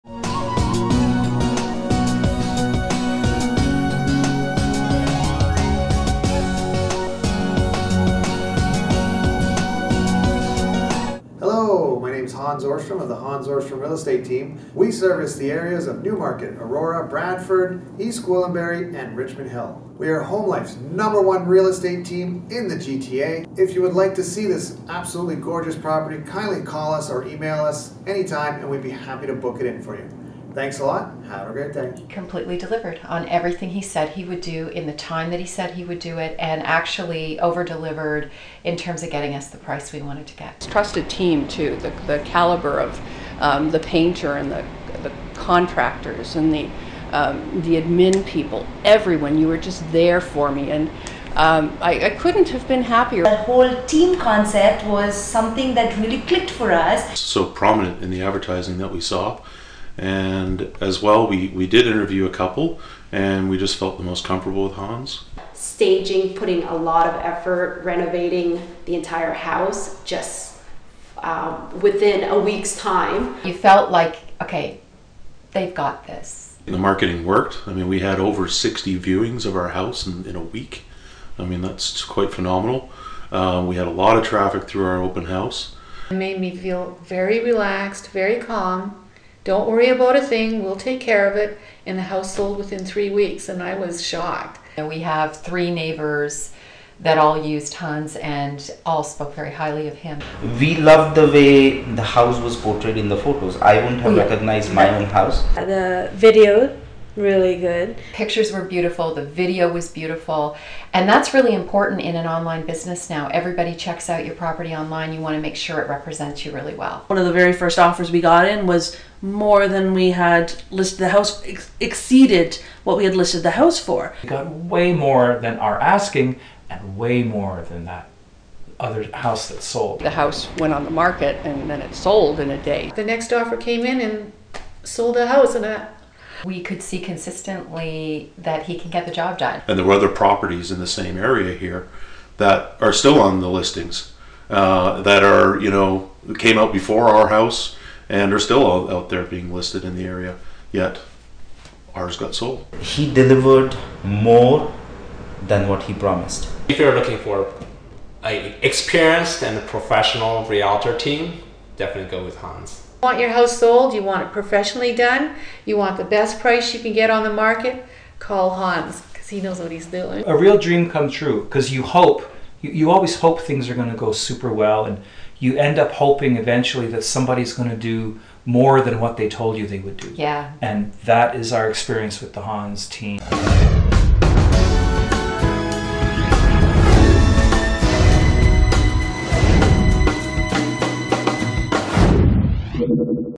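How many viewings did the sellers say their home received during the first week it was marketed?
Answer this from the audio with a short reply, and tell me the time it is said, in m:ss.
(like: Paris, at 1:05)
over 60, at 1:18.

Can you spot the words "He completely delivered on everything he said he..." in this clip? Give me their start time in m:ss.
0:31.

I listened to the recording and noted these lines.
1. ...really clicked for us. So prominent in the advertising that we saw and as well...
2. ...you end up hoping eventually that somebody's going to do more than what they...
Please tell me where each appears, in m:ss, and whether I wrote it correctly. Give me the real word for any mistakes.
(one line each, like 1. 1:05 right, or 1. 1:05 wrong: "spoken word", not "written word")
1. 0:55 right
2. 2:55 right.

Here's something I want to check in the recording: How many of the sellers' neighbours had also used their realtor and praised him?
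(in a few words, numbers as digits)
3.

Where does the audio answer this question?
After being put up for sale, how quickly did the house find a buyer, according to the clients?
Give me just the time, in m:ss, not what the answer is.
2:12.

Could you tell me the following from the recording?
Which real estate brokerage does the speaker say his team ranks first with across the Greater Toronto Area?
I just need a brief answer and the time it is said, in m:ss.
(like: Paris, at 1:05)
HomeLife, at 0:20.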